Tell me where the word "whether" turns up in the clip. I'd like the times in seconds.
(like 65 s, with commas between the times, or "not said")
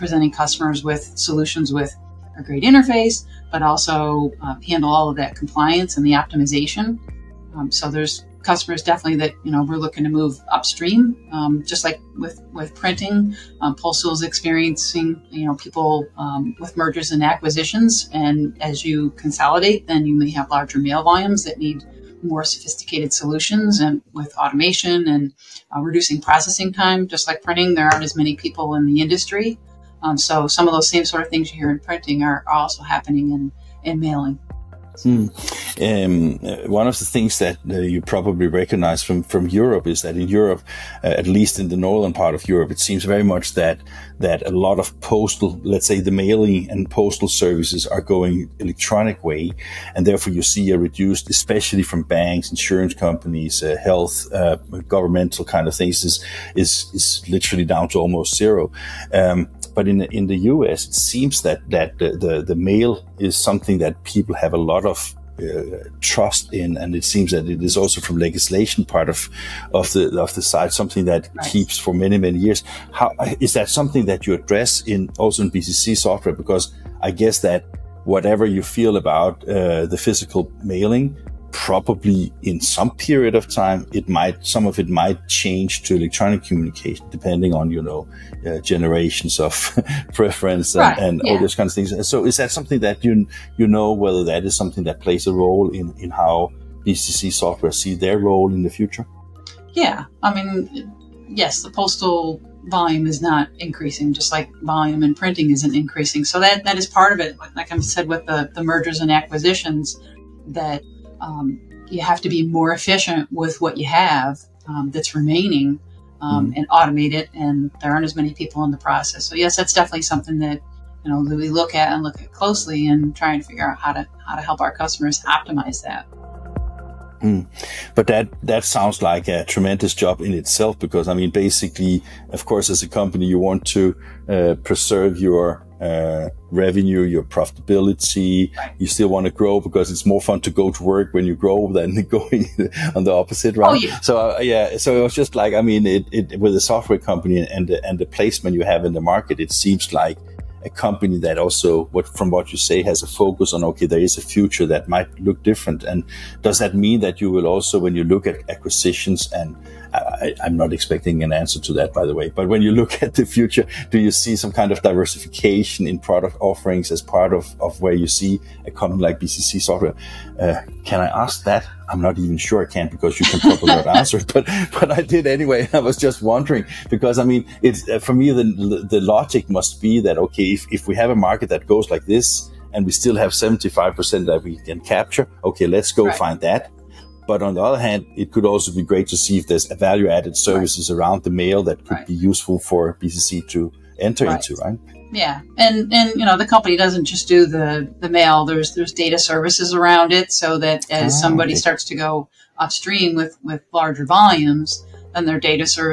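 93 s.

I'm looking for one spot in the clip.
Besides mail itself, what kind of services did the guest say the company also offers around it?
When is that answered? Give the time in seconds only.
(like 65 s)
198 s.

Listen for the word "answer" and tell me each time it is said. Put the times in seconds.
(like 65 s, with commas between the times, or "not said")
161 s, 173 s.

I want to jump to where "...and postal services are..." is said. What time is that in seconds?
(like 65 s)
46 s.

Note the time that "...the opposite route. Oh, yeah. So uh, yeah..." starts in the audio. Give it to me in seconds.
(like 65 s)
143 s.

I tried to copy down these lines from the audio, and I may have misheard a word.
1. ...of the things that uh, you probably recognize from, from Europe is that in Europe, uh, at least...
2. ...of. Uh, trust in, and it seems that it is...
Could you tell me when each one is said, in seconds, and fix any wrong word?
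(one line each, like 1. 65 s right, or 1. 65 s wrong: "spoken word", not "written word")
1. 36 s right
2. 64 s right.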